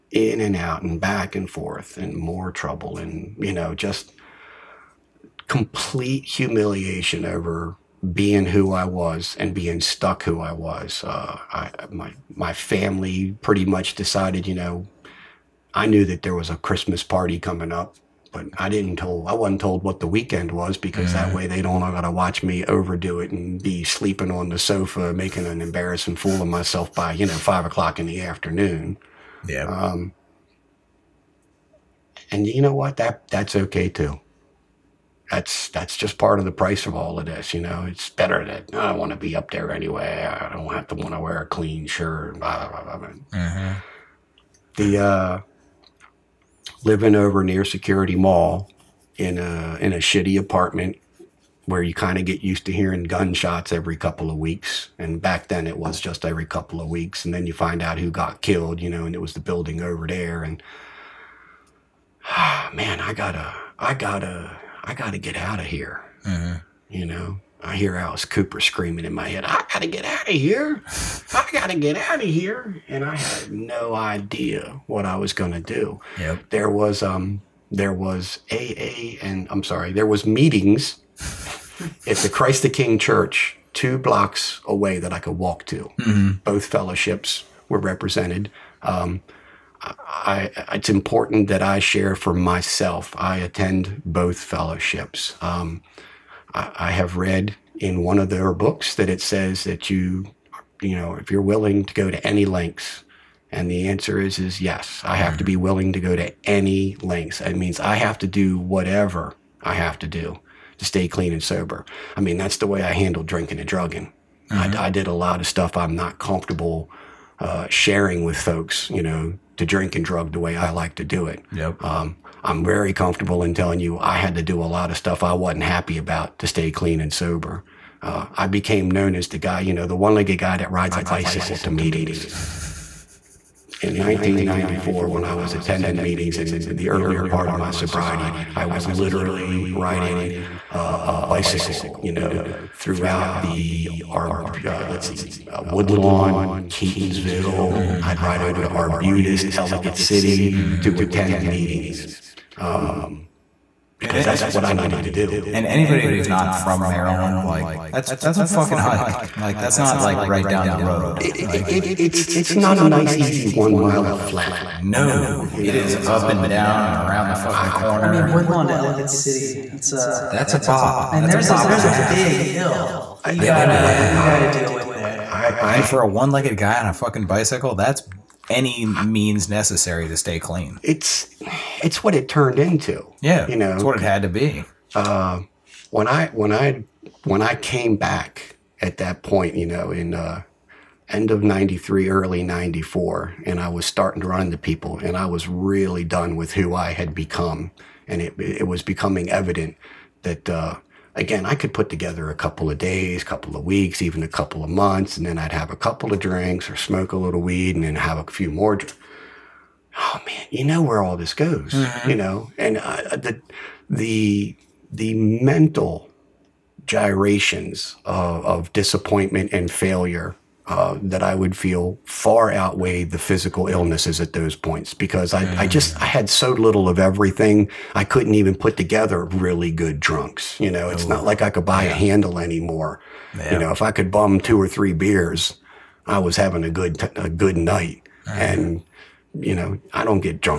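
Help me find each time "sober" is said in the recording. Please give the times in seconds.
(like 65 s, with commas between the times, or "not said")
111 s, 127 s.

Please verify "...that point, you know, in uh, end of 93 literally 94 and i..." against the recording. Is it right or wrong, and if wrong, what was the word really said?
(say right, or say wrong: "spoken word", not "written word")
wrong: "early", not "literally".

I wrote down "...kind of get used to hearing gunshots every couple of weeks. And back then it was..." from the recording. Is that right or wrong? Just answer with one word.
right.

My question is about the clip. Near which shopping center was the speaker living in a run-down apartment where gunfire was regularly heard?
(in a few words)
Security Mall.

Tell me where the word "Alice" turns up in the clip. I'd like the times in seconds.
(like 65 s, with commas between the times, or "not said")
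67 s.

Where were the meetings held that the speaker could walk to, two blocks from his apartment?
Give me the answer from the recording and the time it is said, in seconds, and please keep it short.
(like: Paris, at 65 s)
Christ the King Church, at 82 s.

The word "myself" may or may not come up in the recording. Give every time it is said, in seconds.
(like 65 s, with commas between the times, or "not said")
26 s, 92 s.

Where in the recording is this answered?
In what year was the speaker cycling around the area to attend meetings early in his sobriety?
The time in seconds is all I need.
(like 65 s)
133 s.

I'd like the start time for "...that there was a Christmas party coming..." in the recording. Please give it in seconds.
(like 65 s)
16 s.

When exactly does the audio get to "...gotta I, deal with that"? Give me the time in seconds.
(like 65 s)
174 s.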